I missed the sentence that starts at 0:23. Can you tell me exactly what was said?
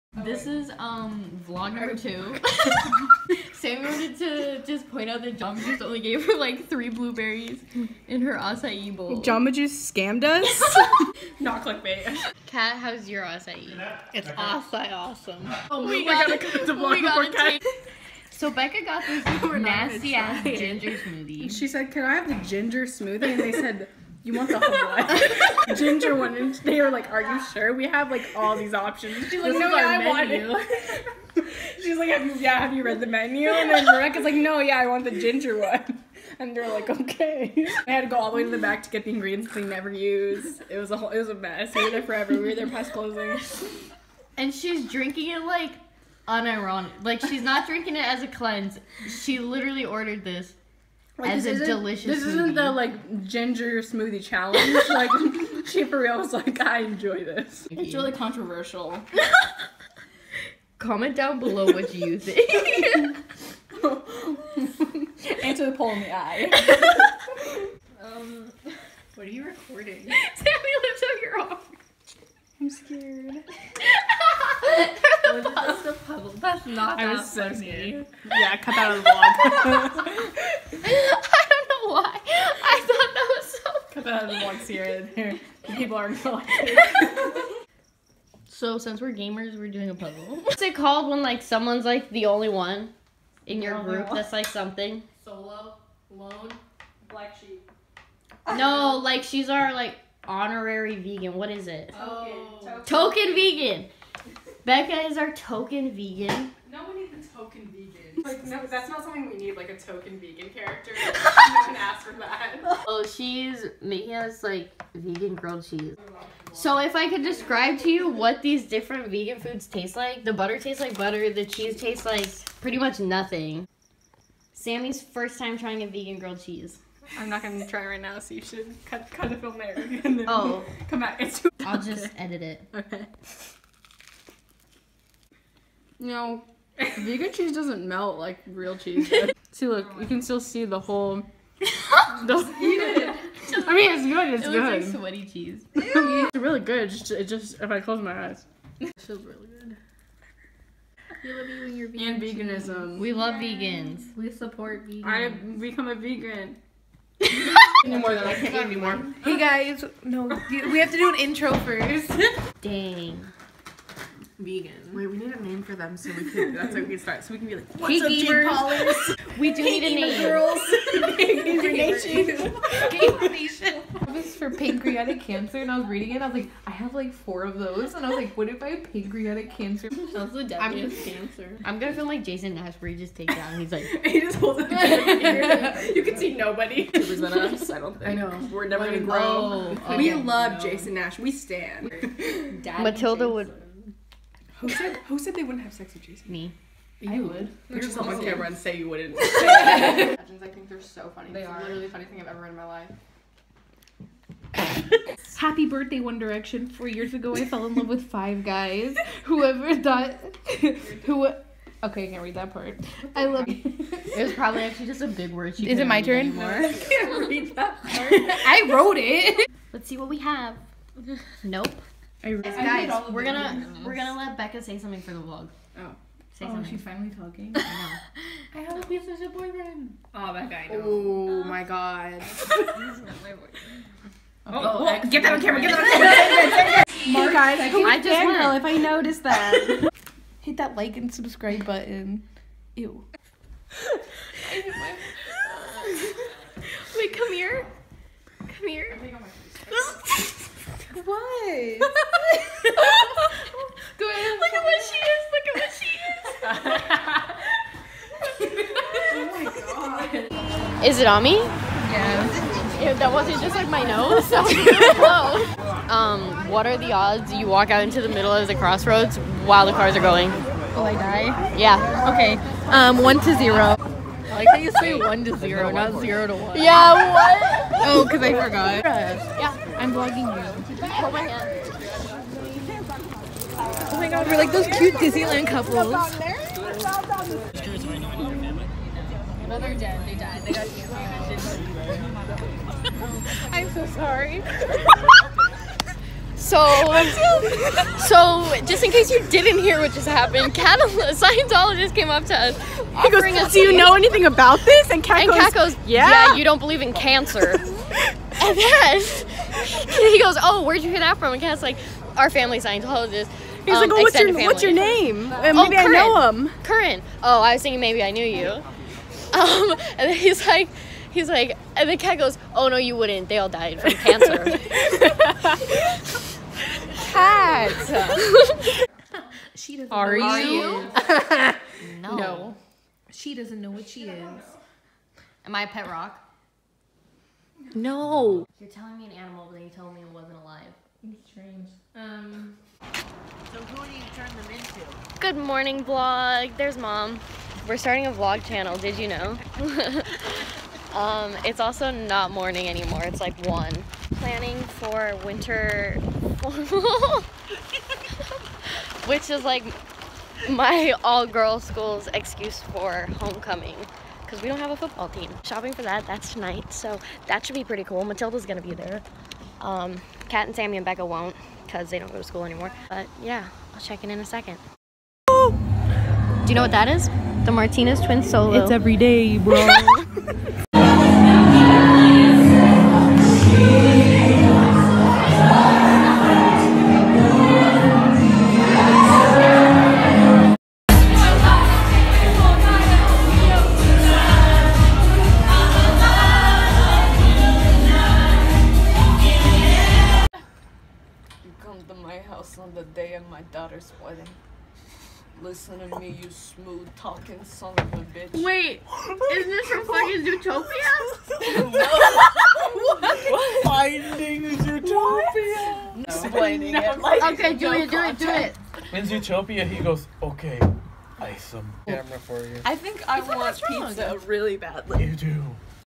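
And they said, you want the whole one.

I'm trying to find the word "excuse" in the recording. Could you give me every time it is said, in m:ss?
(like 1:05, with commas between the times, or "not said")
6:02.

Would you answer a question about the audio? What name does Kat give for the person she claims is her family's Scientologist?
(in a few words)
Curran.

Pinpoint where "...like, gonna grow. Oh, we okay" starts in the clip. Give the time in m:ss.
3:08.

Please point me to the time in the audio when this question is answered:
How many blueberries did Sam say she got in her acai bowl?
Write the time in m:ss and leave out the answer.
0:06.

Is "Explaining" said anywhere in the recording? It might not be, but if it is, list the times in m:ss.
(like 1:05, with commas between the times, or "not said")
6:56.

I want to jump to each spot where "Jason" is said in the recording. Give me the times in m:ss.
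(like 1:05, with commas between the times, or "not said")
3:02, 3:10, 3:16.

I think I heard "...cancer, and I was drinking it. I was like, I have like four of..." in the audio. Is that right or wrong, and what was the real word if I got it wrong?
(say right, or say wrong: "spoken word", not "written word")
wrong: "reading", not "drinking".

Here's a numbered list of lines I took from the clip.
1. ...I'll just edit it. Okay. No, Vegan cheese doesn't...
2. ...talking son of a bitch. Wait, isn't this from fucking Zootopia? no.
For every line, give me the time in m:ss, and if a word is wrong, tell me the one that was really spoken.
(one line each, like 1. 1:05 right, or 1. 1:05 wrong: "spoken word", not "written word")
1. 2:11 right
2. 6:46 right.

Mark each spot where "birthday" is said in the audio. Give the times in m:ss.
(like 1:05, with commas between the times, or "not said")
3:25.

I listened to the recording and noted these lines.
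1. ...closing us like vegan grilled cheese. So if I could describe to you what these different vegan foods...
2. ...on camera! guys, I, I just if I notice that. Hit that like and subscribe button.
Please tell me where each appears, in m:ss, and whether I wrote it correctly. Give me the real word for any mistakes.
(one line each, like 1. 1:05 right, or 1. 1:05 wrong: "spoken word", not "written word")
1. 1:53 wrong: "making", not "closing"
2. 3:56 right.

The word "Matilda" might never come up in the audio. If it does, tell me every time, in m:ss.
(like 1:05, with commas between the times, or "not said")
3:12, 6:08.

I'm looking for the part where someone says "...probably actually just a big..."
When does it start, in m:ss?
3:34.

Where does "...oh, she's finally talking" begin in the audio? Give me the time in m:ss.
3:46.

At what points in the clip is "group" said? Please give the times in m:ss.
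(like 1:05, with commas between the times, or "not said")
1:33.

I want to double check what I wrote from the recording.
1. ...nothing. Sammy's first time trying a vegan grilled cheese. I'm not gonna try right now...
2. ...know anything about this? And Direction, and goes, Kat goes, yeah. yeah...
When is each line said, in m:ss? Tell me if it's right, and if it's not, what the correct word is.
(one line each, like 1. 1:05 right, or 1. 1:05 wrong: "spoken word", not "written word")
1. 2:02 right
2. 5:03 wrong: "Kat", not "Direction".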